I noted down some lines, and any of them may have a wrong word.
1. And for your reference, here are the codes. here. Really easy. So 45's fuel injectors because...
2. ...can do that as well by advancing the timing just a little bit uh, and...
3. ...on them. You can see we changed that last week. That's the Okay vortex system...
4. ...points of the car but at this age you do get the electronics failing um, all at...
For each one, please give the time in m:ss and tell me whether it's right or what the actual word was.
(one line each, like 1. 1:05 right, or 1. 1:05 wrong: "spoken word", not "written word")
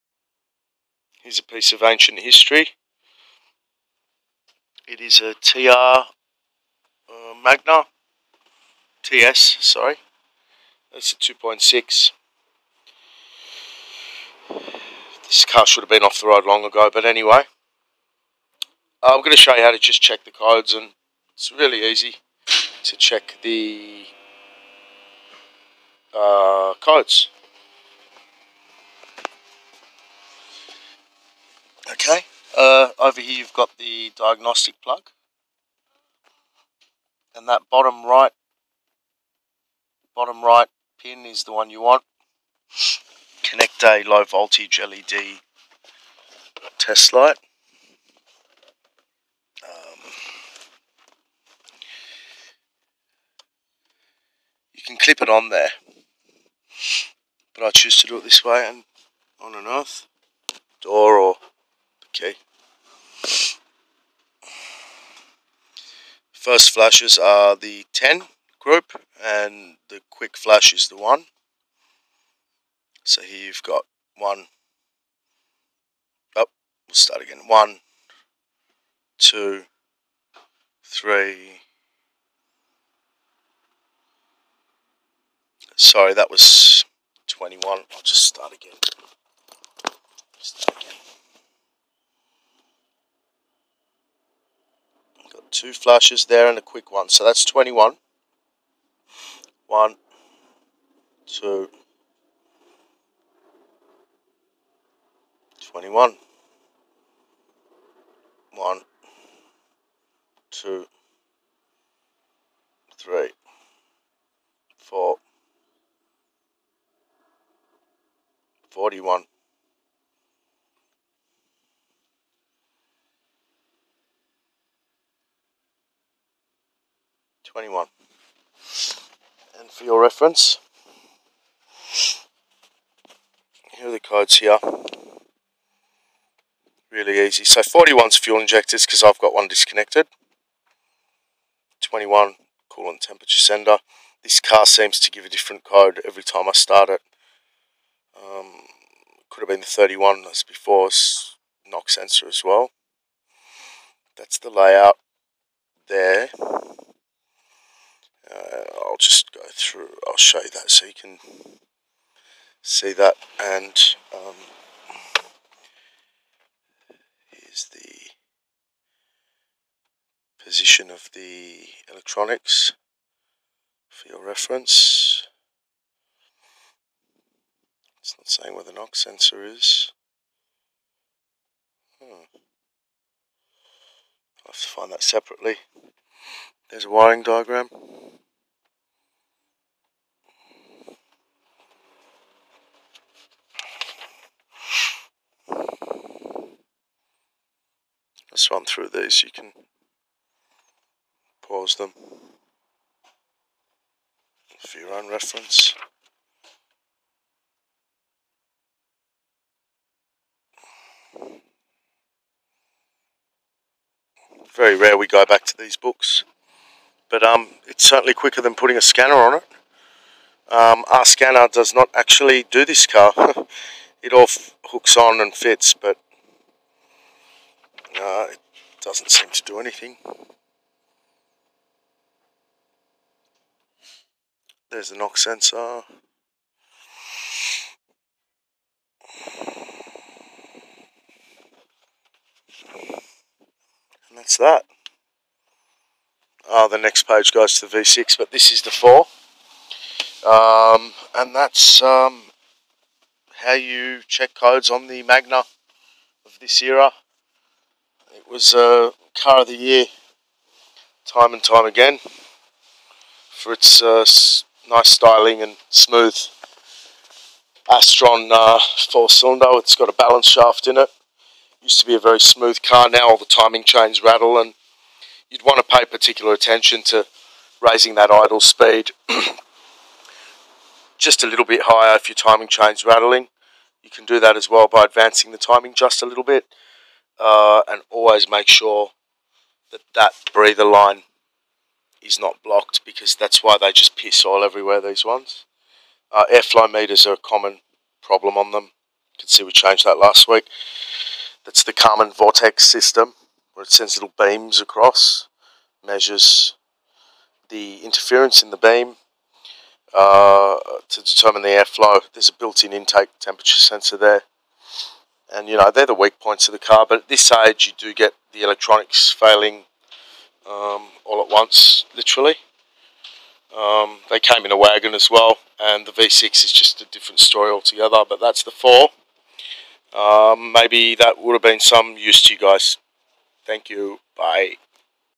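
1. 2:09 wrong: "41", not "45"
2. 4:43 right
3. 4:58 wrong: "Karman", not "Okay"
4. 5:16 right.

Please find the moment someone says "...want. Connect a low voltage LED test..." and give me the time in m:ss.
0:41.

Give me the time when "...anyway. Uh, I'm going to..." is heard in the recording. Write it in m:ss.
0:17.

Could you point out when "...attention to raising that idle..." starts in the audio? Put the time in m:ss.
4:36.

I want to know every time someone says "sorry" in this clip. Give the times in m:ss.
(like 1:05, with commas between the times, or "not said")
0:09, 1:25.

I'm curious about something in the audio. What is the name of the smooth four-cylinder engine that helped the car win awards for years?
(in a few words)
Astron.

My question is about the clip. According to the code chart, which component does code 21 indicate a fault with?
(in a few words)
coolant temperature sender.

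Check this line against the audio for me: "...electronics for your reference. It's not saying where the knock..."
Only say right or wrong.
right.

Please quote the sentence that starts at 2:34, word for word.
That's the layout there through, I'll show you that so you can see that.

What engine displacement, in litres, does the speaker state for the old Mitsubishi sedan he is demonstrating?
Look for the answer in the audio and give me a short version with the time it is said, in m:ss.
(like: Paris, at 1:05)
2.6, at 0:11.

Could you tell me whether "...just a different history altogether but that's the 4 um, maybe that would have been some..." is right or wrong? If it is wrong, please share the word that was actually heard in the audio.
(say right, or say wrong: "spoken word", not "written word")
wrong: "story", not "history".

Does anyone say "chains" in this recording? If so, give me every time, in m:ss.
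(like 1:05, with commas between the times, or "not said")
4:33, 4:42.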